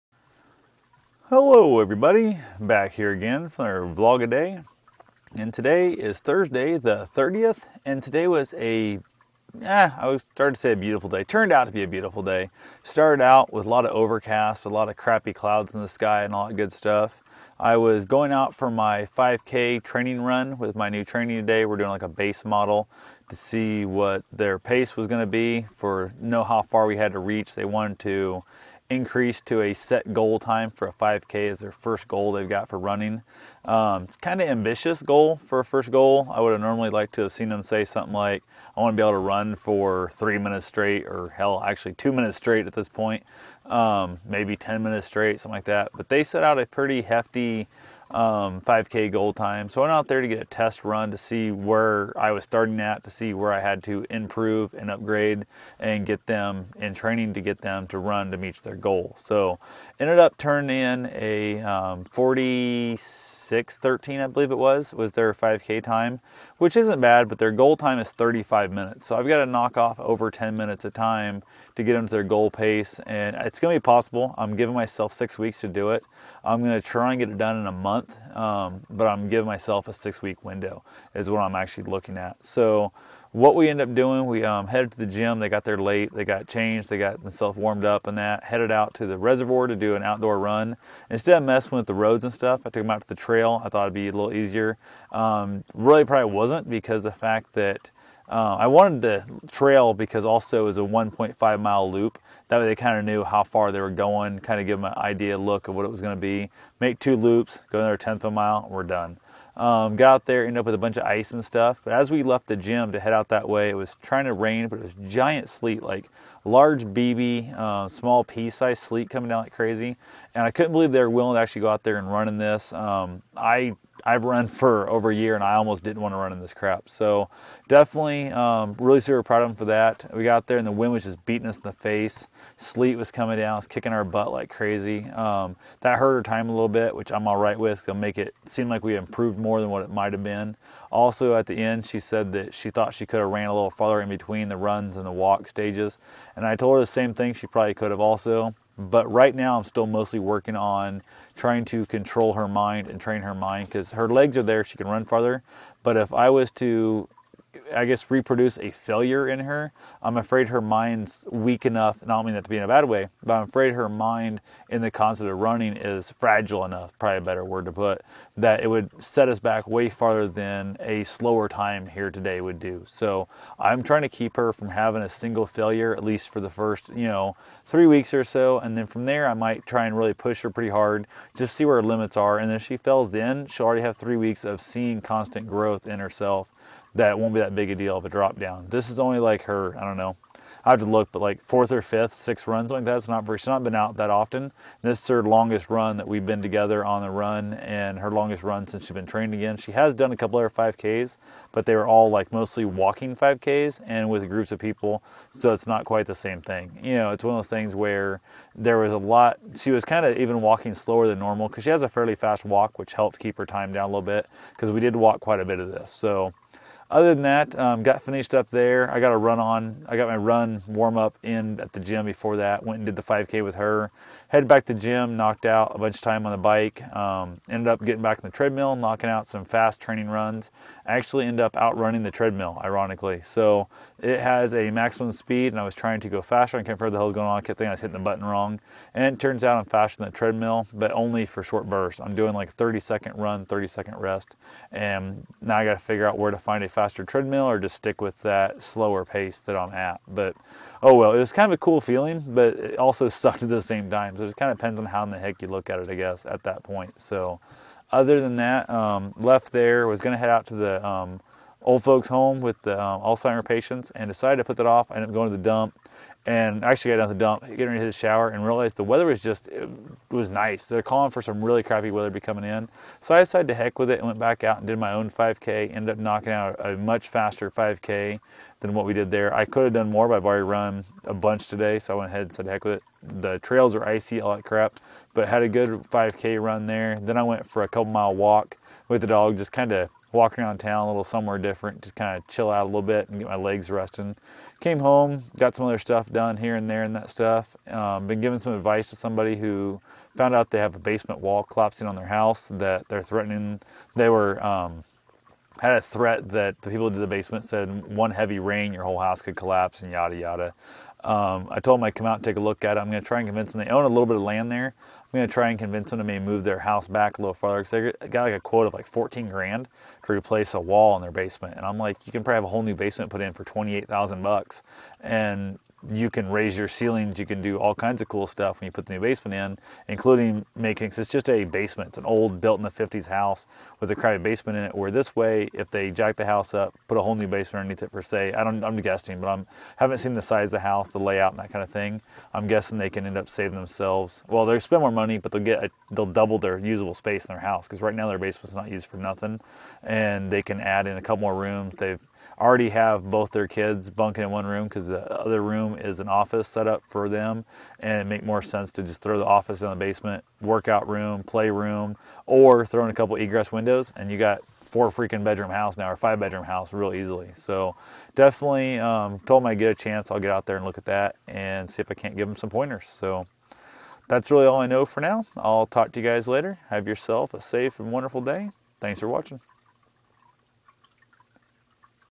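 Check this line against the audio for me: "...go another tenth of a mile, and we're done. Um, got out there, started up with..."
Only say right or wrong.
wrong.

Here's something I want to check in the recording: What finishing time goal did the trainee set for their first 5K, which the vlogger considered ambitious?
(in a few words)
35 minutes.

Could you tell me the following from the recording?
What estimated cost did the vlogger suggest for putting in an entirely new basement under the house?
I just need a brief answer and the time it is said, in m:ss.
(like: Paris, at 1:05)
28,000 dollars, at 5:23.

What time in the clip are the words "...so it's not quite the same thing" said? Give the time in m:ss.
3:25.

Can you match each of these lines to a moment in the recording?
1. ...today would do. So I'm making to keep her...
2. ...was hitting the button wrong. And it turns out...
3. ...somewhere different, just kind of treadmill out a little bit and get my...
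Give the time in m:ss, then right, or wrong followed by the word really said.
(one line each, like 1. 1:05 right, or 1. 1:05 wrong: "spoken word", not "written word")
1. 2:52 wrong: "trying", not "making"
2. 3:57 right
3. 4:51 wrong: "chill", not "treadmill".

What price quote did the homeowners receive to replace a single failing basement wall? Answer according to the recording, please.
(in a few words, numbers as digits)
14,000 dollars.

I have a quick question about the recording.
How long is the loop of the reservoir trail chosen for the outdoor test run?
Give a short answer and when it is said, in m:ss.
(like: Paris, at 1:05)
1.5 miles, at 1:40.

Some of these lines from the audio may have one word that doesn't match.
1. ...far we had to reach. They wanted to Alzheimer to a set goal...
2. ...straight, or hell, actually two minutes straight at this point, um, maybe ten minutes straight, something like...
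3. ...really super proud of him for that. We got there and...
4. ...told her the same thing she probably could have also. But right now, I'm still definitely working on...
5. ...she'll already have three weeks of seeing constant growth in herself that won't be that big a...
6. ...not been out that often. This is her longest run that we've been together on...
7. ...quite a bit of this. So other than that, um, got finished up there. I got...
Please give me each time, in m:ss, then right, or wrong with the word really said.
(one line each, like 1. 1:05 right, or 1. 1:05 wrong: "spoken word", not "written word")
1. 0:26 wrong: "Increase", not "Alzheimer"
2. 0:40 right
3. 2:08 right
4. 2:26 wrong: "mostly", not "definitely"
5. 3:03 right
6. 3:13 right
7. 3:35 right.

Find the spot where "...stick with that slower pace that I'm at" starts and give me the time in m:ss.
4:07.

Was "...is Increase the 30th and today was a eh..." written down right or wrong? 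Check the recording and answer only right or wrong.
wrong.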